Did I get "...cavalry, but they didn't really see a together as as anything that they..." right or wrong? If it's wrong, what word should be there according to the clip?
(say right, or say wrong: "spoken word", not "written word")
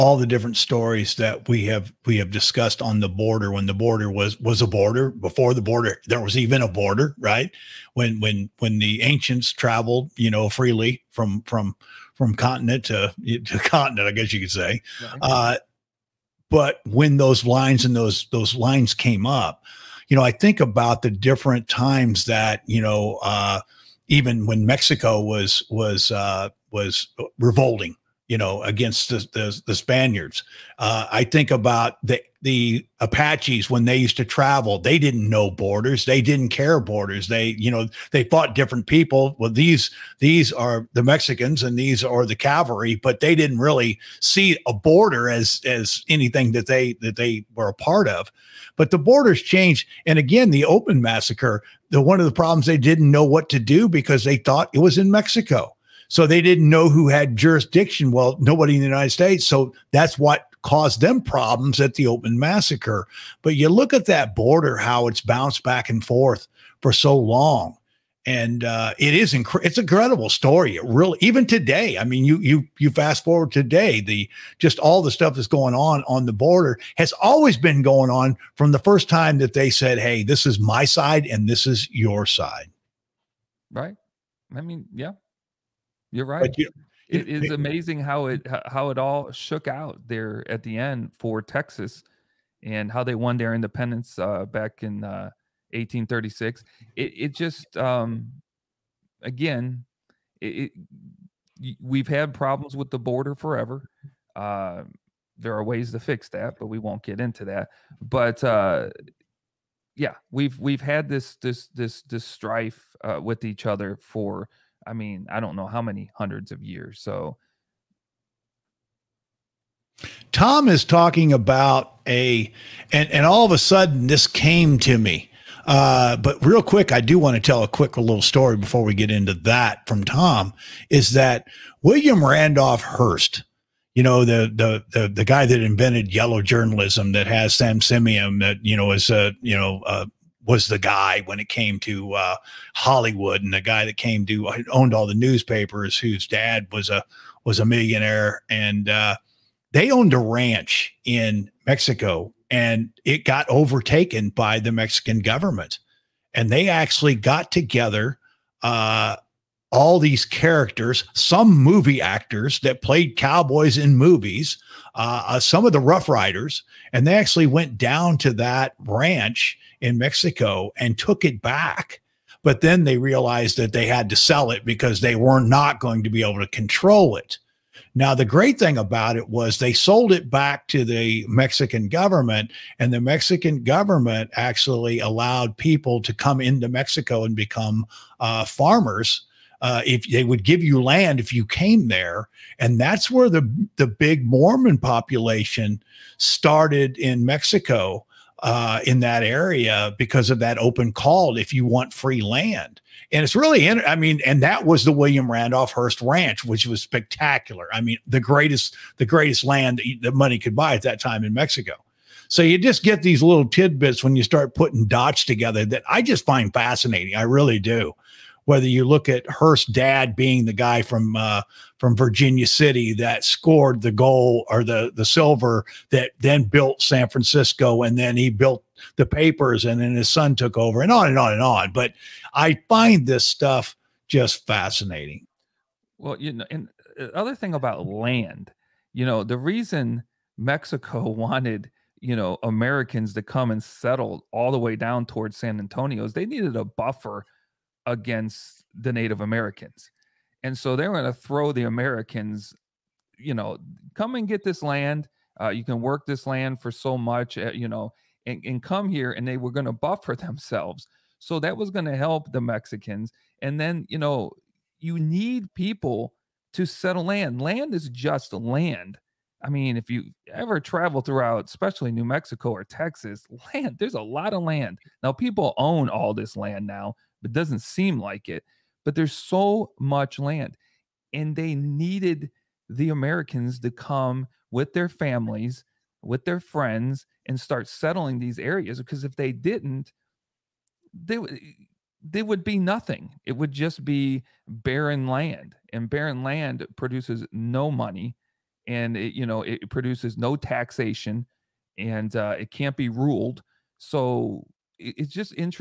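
wrong: "border", not "together".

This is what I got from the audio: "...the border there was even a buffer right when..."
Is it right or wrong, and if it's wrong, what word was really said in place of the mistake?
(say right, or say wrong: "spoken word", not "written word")
wrong: "border", not "buffer".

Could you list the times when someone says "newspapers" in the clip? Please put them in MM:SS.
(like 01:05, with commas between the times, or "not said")
02:25.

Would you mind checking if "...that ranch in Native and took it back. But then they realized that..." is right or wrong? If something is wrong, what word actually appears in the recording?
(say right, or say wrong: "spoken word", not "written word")
wrong: "Mexico", not "Native".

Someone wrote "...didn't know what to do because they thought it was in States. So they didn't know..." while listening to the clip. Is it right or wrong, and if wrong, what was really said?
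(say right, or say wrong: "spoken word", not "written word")
wrong: "Mexico", not "States".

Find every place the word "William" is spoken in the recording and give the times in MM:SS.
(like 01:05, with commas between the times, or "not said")
02:11, 03:24.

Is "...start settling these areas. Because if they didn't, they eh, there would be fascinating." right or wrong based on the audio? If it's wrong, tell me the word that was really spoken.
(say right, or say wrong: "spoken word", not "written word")
wrong: "nothing", not "fascinating".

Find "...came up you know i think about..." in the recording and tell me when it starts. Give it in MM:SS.
00:18.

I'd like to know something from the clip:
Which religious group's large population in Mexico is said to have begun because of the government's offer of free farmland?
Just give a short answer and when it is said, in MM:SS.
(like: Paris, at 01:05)
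Mormon, at 03:14.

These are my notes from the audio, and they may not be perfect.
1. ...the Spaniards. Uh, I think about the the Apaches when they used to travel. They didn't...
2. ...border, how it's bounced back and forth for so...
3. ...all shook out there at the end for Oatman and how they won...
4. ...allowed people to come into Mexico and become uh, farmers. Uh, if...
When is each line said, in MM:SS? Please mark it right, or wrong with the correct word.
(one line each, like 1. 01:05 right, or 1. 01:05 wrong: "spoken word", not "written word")
1. 00:29 right
2. 01:04 right
3. 01:28 wrong: "Texas", not "Oatman"
4. 03:04 right.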